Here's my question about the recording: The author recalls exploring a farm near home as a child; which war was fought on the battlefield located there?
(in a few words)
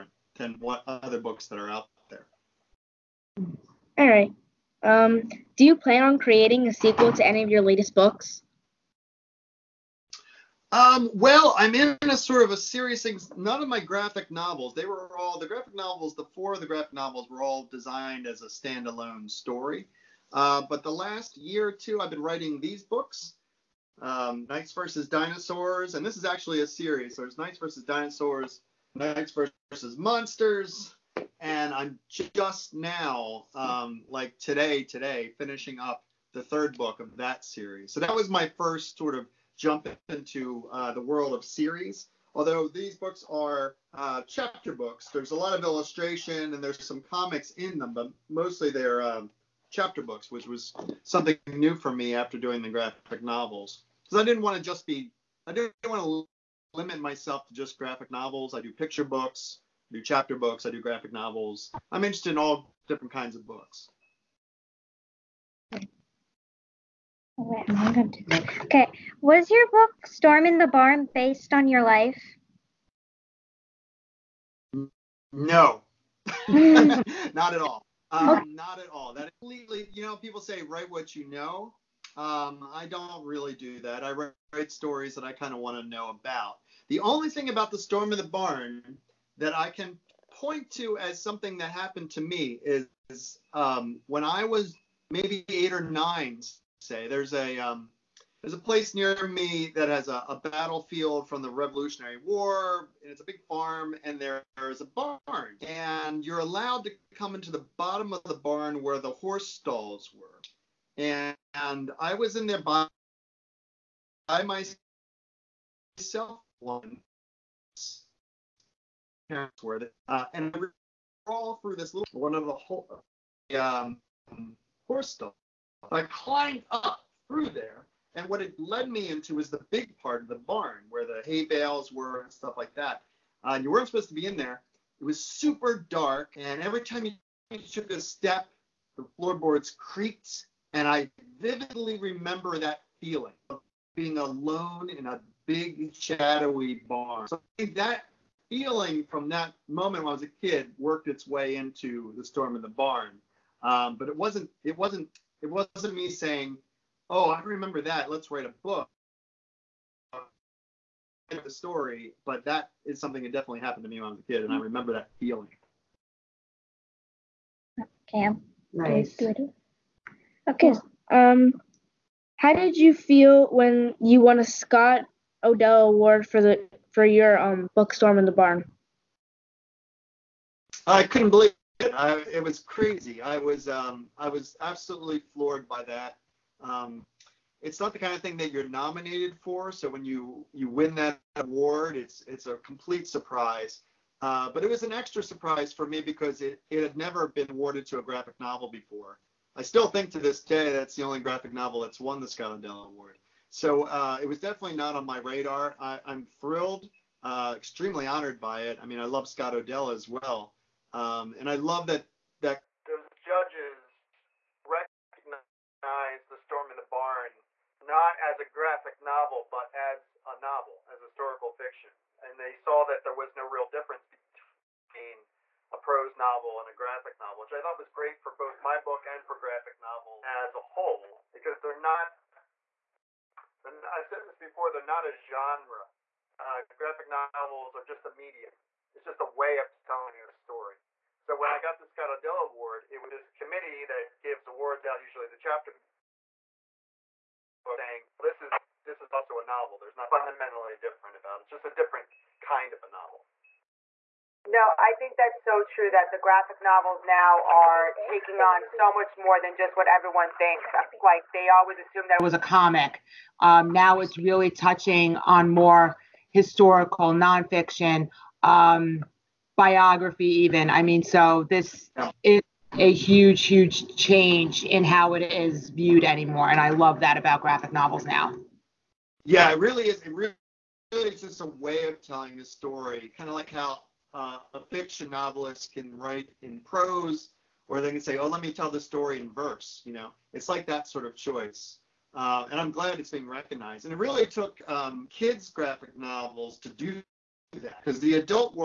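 Revolutionary War.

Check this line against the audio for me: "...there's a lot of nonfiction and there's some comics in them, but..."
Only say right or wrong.
wrong.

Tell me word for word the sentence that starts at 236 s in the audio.
Uh, graphic novels are just a medium.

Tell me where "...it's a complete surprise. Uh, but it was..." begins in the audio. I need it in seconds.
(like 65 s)
192 s.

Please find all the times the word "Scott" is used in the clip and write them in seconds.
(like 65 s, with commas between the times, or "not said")
174 s, 202 s, 209 s, 241 s.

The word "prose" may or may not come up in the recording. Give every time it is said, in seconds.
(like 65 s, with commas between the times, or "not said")
225 s, 286 s.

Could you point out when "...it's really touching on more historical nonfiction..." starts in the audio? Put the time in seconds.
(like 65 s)
263 s.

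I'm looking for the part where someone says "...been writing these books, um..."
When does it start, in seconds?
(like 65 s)
22 s.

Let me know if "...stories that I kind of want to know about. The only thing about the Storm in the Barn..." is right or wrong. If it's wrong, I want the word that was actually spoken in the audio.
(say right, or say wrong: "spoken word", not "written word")
right.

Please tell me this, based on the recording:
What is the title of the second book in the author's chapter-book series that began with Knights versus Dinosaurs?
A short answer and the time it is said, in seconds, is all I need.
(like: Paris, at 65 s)
Knights versus Monsters, at 28 s.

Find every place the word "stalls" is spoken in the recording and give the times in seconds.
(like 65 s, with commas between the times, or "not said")
109 s, 125 s.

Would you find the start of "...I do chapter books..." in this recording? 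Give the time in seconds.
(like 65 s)
59 s.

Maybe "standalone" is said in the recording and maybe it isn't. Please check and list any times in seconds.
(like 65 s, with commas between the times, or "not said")
18 s.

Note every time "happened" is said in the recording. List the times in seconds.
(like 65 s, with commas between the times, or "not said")
91 s, 163 s.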